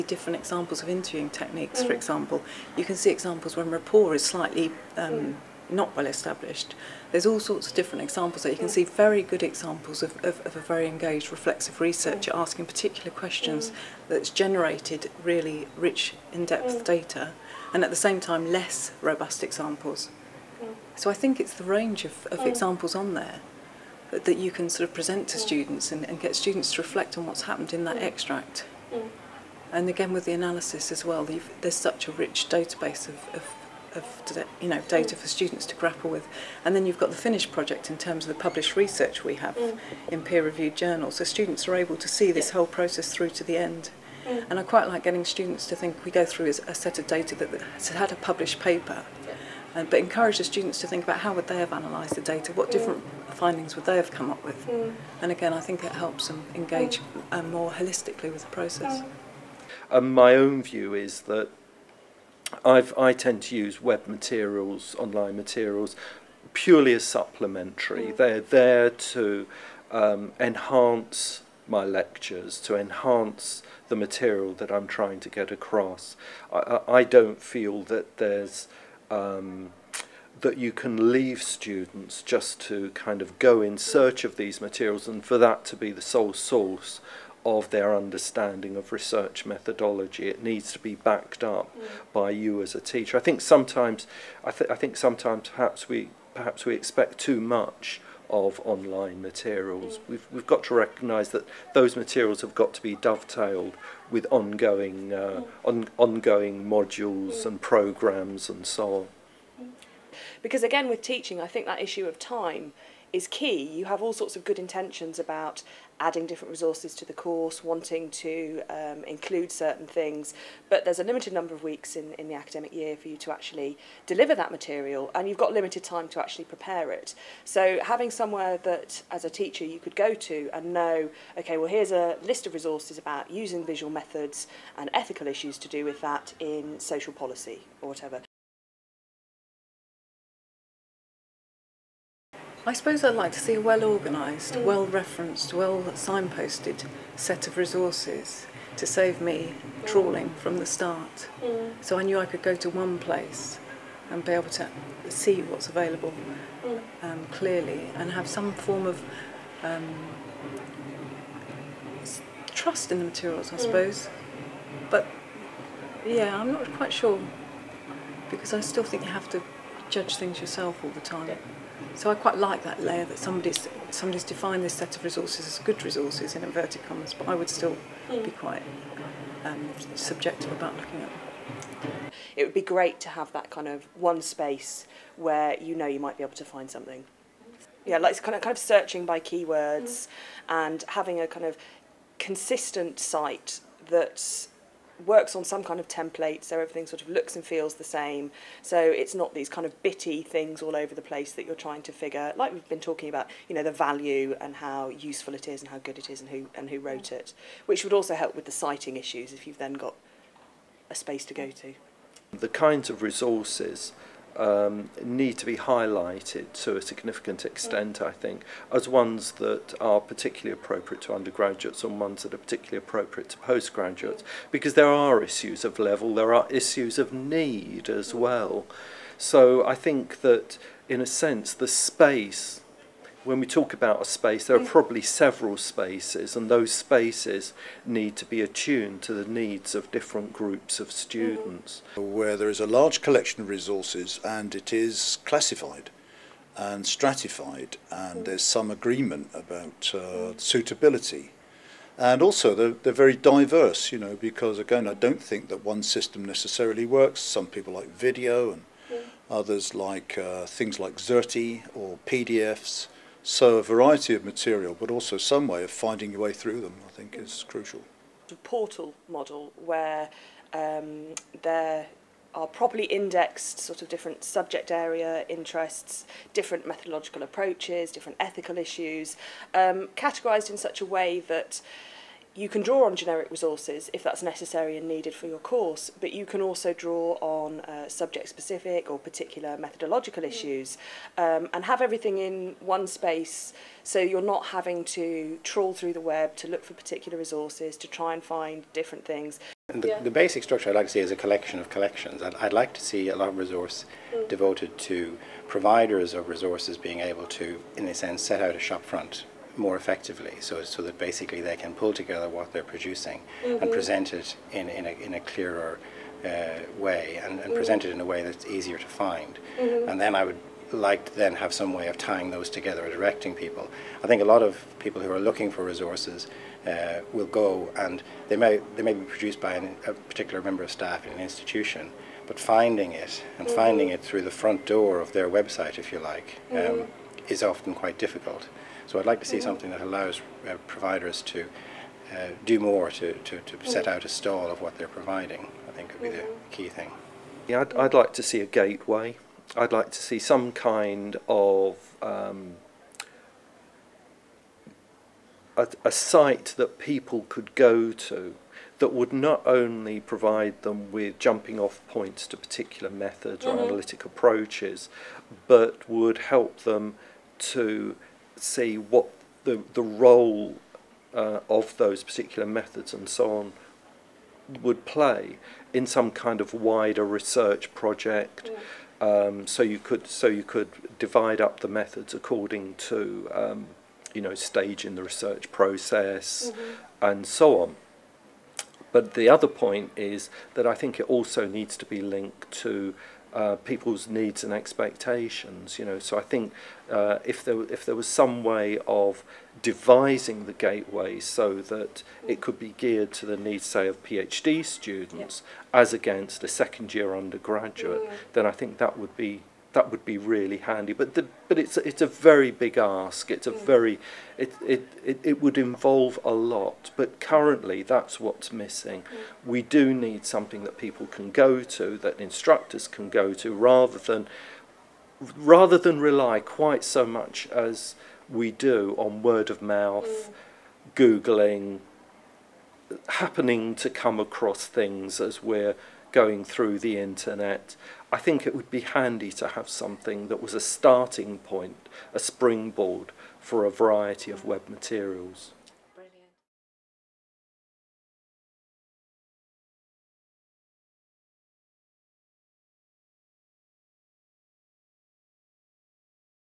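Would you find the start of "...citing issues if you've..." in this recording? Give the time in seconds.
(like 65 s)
208 s.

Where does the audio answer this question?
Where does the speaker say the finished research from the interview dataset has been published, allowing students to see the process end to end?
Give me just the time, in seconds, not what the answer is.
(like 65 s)
40 s.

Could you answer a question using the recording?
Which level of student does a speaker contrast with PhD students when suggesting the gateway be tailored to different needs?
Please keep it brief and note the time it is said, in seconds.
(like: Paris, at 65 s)
second year undergraduate, at 406 s.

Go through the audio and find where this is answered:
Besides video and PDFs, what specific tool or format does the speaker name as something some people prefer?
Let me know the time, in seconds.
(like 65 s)
260 s.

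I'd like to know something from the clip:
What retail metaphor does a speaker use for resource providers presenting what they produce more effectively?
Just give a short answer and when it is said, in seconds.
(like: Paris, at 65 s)
shop front, at 308 s.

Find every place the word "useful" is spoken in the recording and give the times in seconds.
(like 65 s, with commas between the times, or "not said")
204 s.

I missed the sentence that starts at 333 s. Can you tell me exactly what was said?
finding it through the front door of their website, if you like, um, mm.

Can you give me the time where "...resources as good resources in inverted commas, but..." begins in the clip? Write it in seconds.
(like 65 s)
175 s.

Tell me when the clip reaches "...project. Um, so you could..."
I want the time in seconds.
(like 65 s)
377 s.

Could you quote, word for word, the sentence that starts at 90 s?
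It needs to be backed up mm.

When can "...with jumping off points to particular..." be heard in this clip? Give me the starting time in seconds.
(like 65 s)
360 s.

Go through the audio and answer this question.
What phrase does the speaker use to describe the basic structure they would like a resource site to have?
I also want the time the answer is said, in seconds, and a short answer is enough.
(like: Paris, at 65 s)
a collection of collections, at 301 s.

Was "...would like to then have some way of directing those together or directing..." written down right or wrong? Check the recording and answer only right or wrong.
wrong.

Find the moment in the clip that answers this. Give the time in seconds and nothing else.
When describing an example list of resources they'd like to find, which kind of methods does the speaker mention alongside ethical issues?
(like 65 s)
133 s.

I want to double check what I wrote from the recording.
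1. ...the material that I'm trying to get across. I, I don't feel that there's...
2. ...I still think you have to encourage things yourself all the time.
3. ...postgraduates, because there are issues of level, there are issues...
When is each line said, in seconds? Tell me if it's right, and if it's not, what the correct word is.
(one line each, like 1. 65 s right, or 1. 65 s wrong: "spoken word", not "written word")
1. 73 s right
2. 168 s wrong: "judge", not "encourage"
3. 223 s right.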